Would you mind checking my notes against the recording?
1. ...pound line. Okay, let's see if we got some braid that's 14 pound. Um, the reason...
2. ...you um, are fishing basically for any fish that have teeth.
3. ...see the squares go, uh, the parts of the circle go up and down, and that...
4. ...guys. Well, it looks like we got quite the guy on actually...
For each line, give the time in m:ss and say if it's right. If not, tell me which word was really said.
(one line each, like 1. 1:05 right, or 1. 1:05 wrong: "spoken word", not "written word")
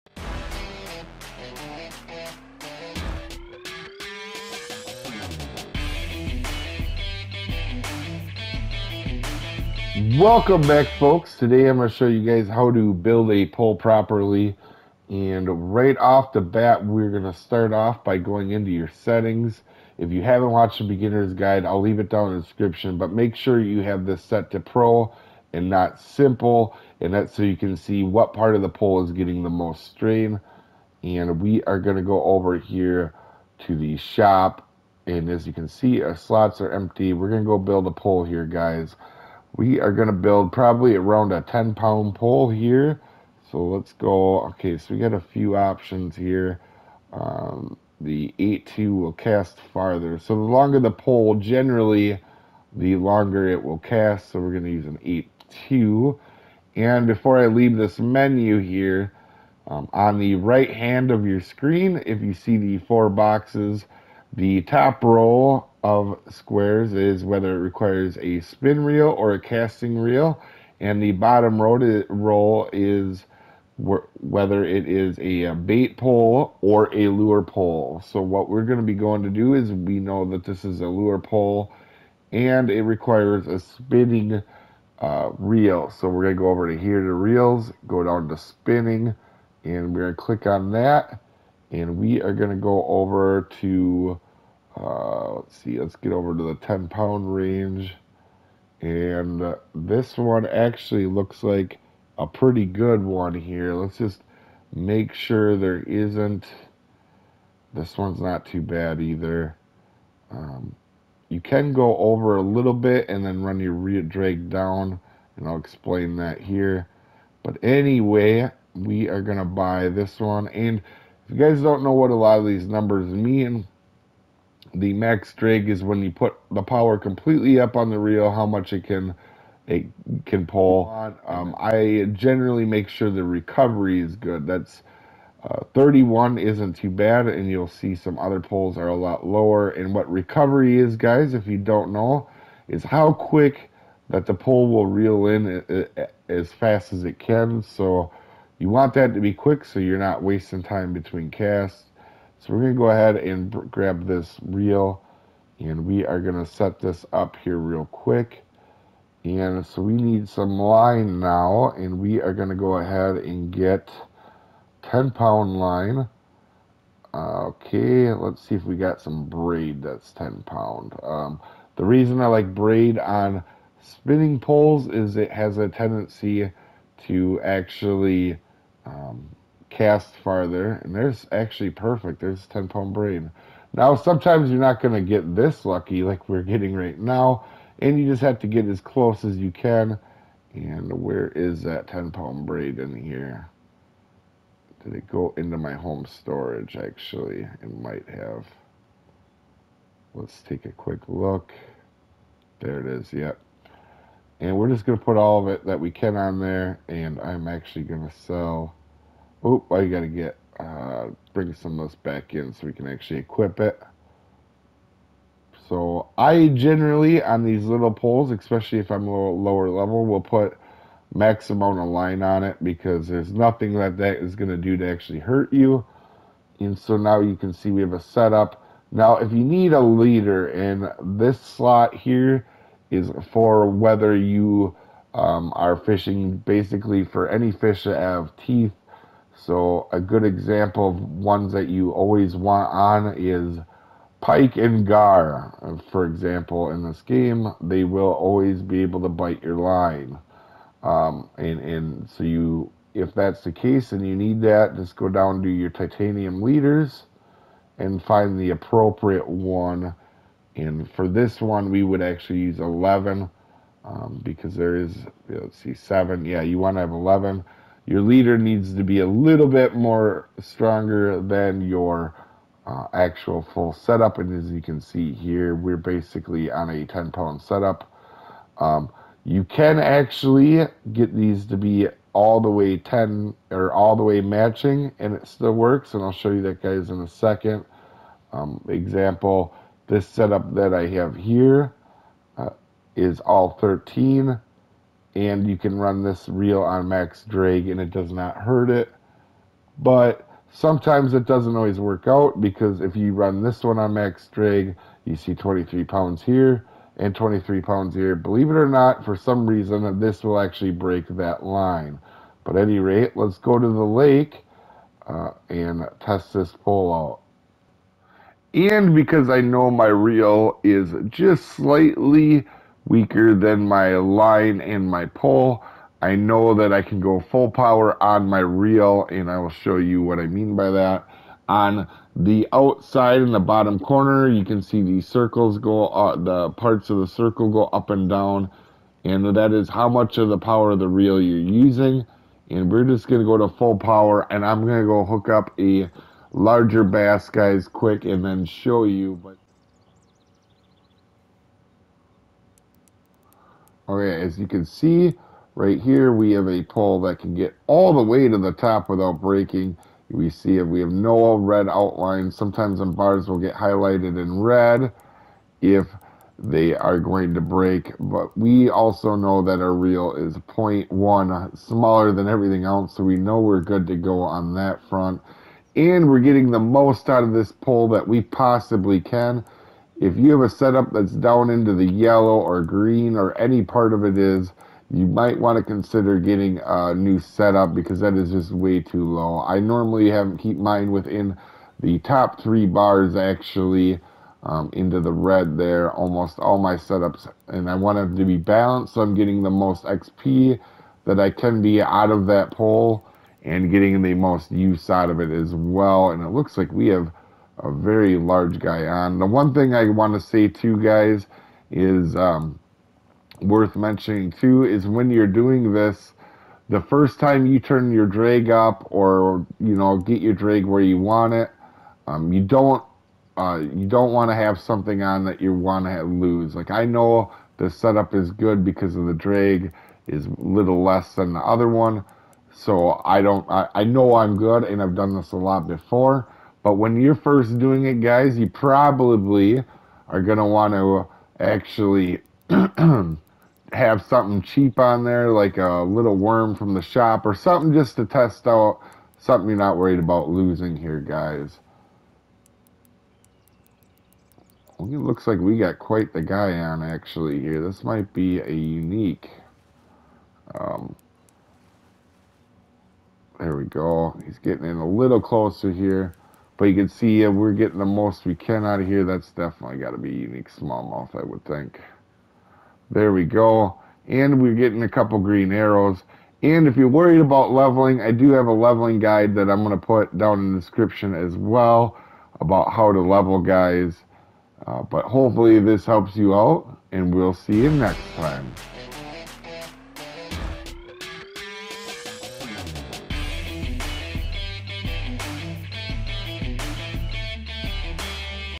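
1. 2:45 wrong: "10", not "14"
2. 3:54 right
3. 5:34 wrong: "circles", not "squares"
4. 7:30 right.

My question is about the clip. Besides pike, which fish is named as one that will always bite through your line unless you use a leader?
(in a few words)
Gar.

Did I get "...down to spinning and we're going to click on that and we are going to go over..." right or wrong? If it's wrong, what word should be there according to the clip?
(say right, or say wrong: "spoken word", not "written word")
right.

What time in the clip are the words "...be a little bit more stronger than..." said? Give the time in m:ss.
4:28.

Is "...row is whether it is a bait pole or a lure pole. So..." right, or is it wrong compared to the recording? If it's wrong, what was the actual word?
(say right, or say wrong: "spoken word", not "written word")
right.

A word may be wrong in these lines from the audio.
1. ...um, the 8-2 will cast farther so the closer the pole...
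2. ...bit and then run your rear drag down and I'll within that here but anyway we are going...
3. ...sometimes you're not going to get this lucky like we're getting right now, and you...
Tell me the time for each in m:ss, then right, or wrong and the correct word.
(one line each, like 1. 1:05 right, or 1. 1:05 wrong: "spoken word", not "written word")
1. 0:47 wrong: "longer", not "closer"
2. 1:52 wrong: "explain", not "within"
3. 3:03 right.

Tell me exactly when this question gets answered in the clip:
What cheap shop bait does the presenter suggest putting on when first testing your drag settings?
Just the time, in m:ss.
7:25.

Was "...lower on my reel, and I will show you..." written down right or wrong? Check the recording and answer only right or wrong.
wrong.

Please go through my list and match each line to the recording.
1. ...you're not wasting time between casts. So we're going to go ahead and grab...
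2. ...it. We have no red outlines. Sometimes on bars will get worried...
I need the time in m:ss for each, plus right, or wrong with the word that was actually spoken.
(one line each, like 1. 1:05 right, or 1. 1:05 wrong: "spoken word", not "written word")
1. 2:29 right
2. 6:00 wrong: "highlighted", not "worried".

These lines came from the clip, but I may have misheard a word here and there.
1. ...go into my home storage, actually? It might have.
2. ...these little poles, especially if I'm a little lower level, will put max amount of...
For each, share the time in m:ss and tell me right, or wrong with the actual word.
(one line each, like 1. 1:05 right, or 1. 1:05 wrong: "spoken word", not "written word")
1. 3:15 right
2. 3:37 right.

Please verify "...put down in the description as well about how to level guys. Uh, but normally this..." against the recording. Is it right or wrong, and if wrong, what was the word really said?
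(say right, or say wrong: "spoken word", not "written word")
wrong: "hopefully", not "normally".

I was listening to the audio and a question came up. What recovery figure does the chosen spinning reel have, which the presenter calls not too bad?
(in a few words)
31.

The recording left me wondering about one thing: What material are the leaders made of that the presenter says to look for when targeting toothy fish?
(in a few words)
Titanium.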